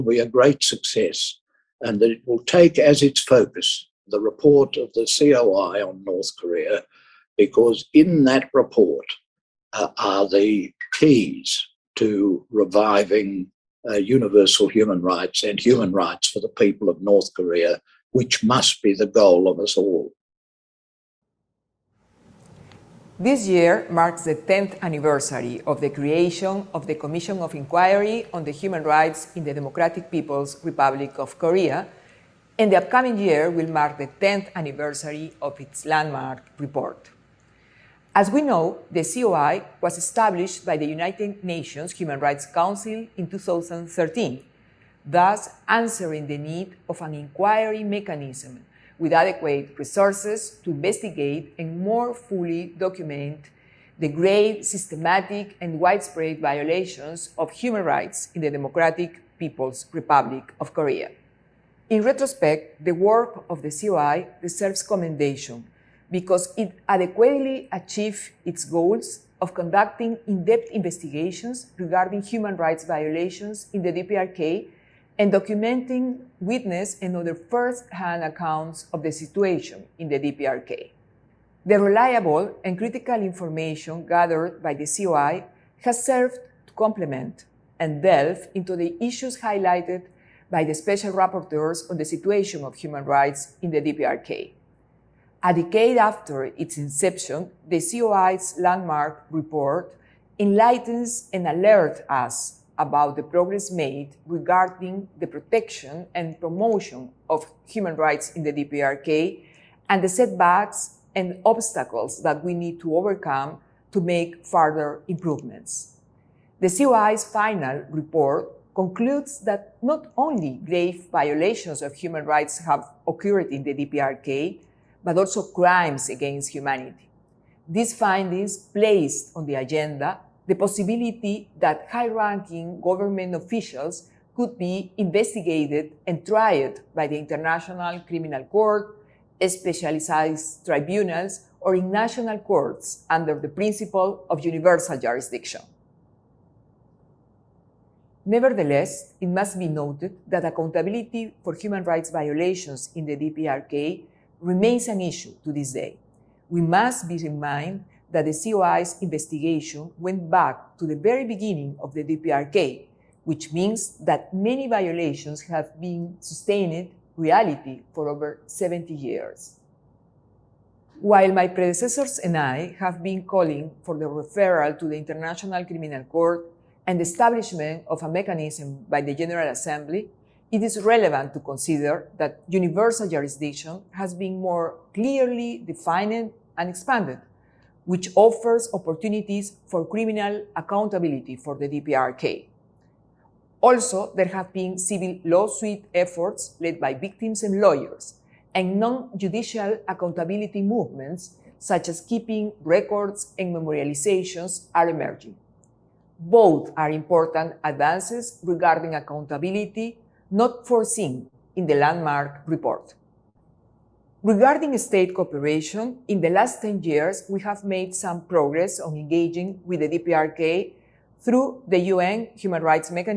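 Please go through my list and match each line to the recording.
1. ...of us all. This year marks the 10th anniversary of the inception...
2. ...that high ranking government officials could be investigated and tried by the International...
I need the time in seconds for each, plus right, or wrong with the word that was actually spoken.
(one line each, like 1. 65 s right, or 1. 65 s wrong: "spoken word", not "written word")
1. 19 s wrong: "creation", not "inception"
2. 131 s right.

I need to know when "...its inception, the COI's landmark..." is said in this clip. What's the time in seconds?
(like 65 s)
96 s.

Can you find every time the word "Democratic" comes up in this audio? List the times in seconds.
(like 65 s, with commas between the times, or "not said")
29 s, 58 s.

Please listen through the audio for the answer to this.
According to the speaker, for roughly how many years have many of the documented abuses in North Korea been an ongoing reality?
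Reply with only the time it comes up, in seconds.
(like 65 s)
168 s.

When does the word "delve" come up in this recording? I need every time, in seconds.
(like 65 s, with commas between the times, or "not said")
88 s.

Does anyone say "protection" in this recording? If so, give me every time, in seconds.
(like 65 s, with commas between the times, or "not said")
105 s.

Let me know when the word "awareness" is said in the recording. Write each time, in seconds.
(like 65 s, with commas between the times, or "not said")
not said.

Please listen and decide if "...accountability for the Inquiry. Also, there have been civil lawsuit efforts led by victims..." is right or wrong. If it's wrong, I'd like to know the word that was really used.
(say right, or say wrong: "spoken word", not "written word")
wrong: "DPRK", not "Inquiry".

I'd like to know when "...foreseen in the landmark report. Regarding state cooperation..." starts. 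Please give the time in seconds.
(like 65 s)
210 s.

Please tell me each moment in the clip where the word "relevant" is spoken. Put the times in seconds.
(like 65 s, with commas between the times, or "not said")
180 s.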